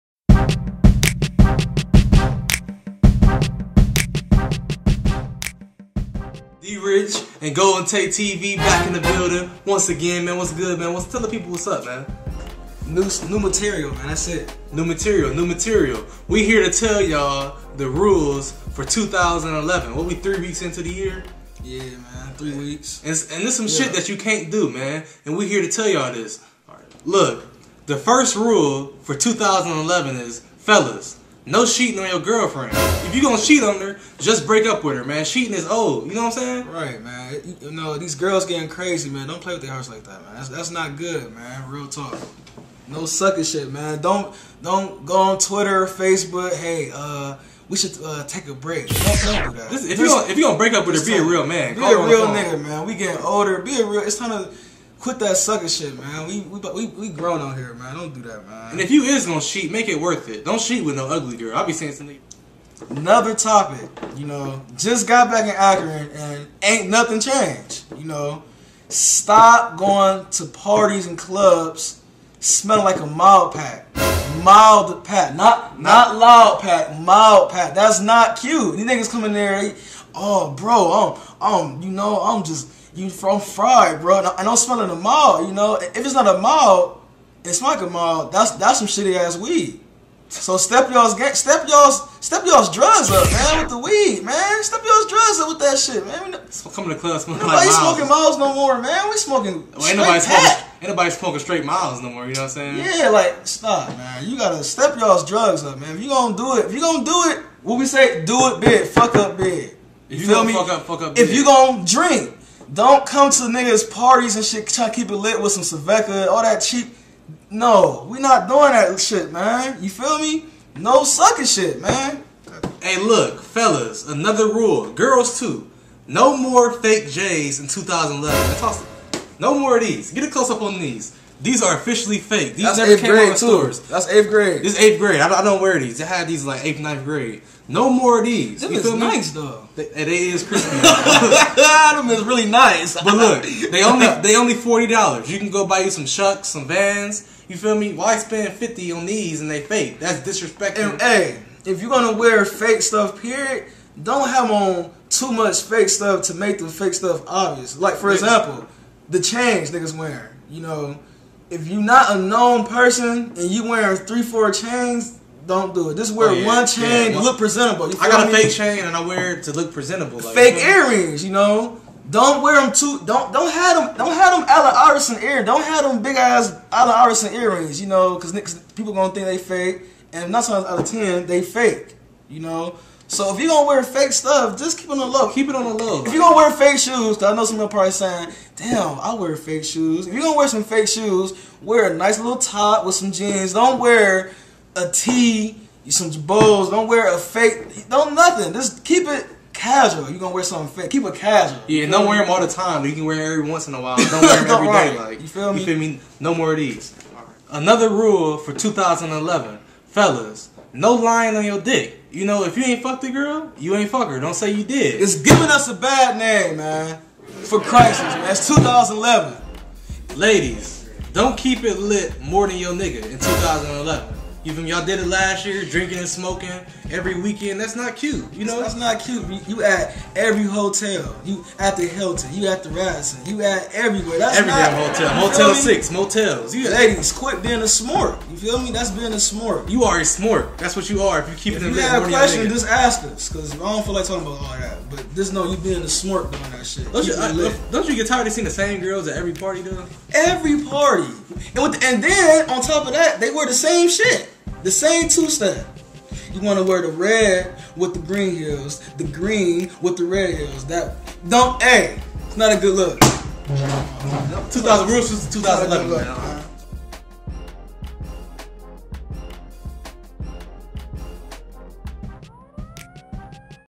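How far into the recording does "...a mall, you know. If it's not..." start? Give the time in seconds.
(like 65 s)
84 s.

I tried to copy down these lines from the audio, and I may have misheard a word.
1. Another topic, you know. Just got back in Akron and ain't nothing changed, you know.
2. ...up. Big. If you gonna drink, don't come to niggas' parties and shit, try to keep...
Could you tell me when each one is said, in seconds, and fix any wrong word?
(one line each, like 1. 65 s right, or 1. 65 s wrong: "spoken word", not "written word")
1. 62 s right
2. 111 s right.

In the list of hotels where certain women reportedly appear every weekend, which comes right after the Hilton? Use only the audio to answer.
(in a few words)
Radisson.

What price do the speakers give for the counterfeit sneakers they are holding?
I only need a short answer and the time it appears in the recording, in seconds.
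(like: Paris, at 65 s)
$40, at 144 s.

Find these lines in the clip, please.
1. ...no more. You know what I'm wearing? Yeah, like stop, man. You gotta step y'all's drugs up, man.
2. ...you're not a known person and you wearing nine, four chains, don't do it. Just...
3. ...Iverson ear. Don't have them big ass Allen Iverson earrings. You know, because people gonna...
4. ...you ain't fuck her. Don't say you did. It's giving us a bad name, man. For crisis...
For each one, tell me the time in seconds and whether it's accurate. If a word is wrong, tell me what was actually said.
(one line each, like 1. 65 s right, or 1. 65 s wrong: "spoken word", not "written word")
1. 102 s wrong: "saying", not "wearing"
2. 161 s wrong: "three", not "nine"
3. 174 s right
4. 213 s right.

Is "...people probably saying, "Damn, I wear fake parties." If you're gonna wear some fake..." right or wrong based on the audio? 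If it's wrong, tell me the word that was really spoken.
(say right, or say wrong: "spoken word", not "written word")
wrong: "shoes", not "parties".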